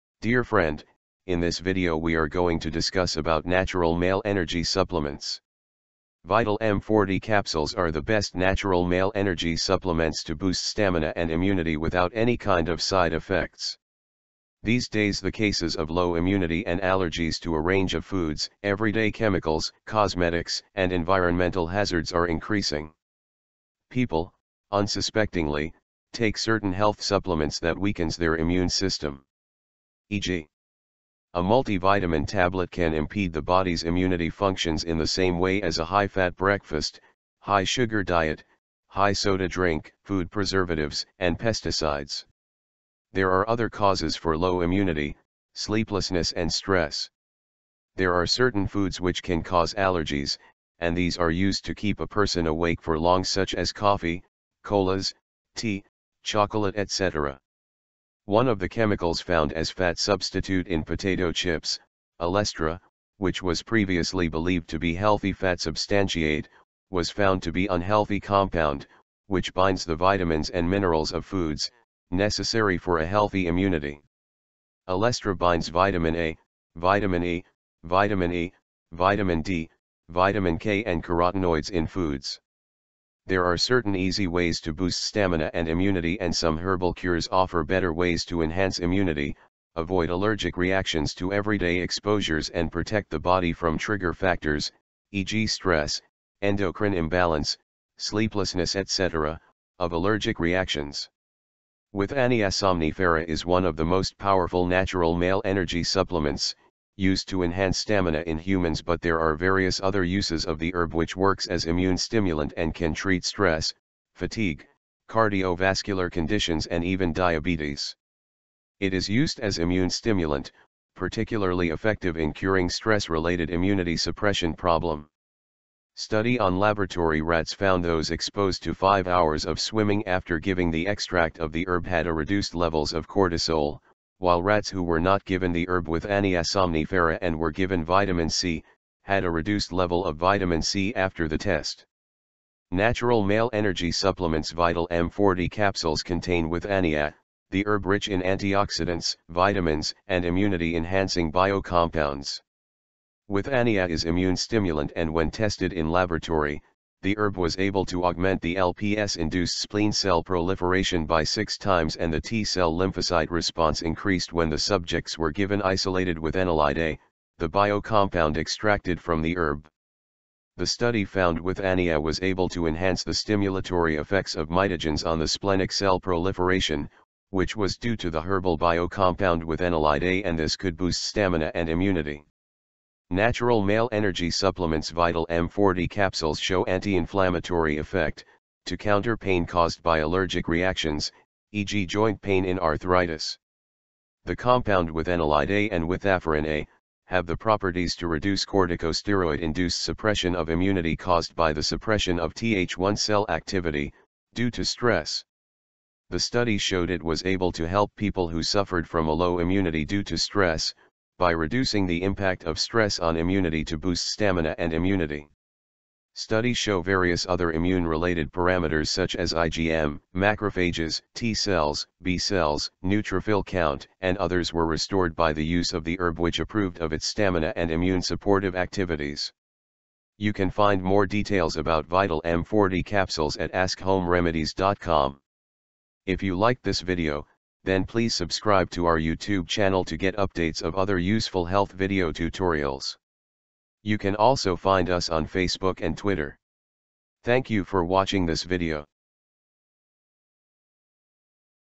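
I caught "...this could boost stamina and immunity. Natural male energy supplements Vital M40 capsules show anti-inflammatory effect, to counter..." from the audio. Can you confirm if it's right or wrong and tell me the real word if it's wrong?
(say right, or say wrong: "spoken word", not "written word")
right.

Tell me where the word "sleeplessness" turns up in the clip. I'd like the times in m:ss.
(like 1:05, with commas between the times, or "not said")
0:45, 1:37.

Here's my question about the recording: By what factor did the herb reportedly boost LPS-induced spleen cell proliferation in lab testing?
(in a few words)
six times.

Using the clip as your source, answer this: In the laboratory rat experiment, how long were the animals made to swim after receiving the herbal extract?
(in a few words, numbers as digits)
5 hours.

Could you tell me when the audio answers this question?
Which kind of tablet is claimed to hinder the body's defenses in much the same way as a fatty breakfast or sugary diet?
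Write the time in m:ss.
0:31.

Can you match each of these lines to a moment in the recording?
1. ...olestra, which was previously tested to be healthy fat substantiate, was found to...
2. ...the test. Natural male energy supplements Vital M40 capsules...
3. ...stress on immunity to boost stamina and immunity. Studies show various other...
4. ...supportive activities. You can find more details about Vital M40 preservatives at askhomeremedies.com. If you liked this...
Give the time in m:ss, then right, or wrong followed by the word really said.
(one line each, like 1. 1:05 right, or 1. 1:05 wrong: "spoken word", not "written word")
1. 1:02 wrong: "believed", not "tested"
2. 2:21 right
3. 3:32 right
4. 3:48 wrong: "capsules", not "preservatives".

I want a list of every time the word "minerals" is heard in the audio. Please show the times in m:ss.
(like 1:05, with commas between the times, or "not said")
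1:10.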